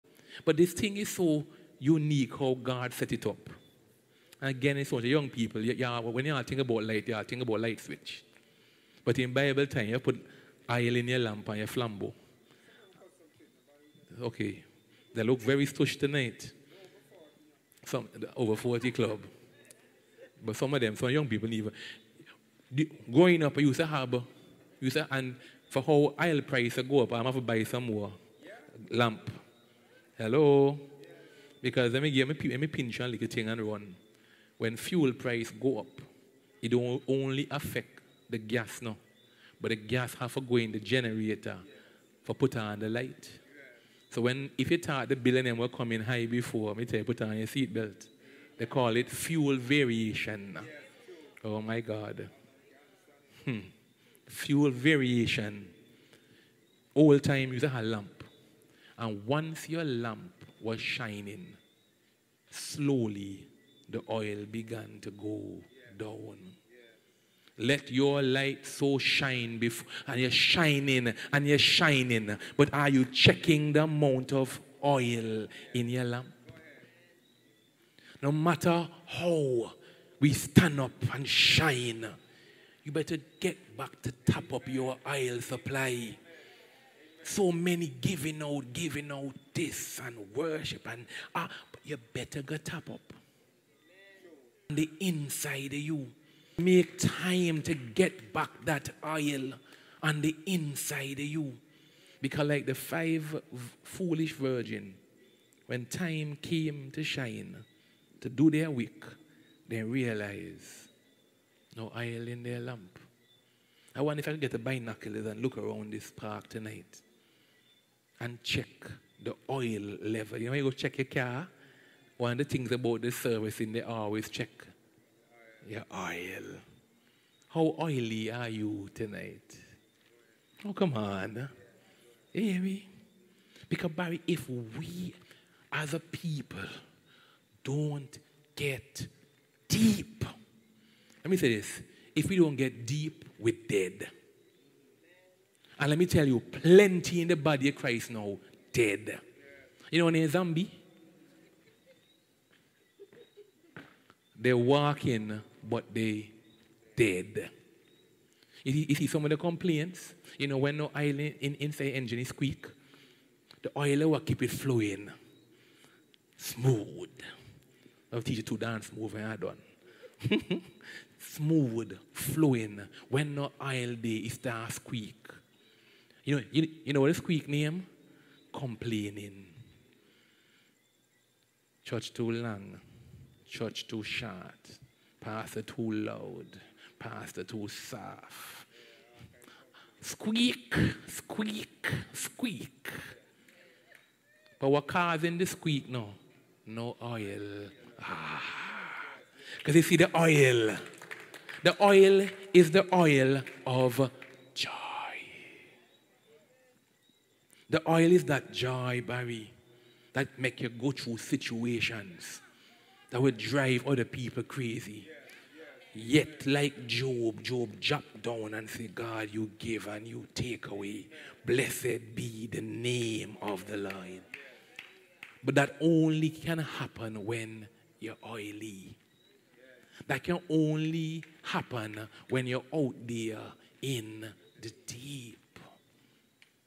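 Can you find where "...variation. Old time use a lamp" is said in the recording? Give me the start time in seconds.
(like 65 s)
54 s.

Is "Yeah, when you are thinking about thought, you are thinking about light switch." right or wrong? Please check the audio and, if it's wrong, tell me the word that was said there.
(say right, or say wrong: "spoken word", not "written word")
wrong: "light", not "thought".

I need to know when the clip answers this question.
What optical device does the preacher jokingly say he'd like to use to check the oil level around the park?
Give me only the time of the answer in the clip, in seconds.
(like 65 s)
114 s.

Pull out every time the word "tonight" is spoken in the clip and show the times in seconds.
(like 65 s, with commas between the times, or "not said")
15 s, 116 s, 128 s.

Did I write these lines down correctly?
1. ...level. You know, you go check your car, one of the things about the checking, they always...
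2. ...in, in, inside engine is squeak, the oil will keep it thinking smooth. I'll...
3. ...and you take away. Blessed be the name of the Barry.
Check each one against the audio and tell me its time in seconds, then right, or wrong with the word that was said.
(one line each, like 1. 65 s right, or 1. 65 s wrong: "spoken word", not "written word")
1. 120 s wrong: "servicing", not "checking"
2. 161 s wrong: "flowing", not "thinking"
3. 219 s wrong: "Lord", not "Barry".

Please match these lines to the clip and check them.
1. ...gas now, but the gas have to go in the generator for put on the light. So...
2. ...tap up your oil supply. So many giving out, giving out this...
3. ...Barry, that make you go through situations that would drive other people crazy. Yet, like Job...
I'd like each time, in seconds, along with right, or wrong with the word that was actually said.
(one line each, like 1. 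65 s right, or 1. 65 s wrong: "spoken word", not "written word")
1. 38 s right
2. 84 s right
3. 209 s right.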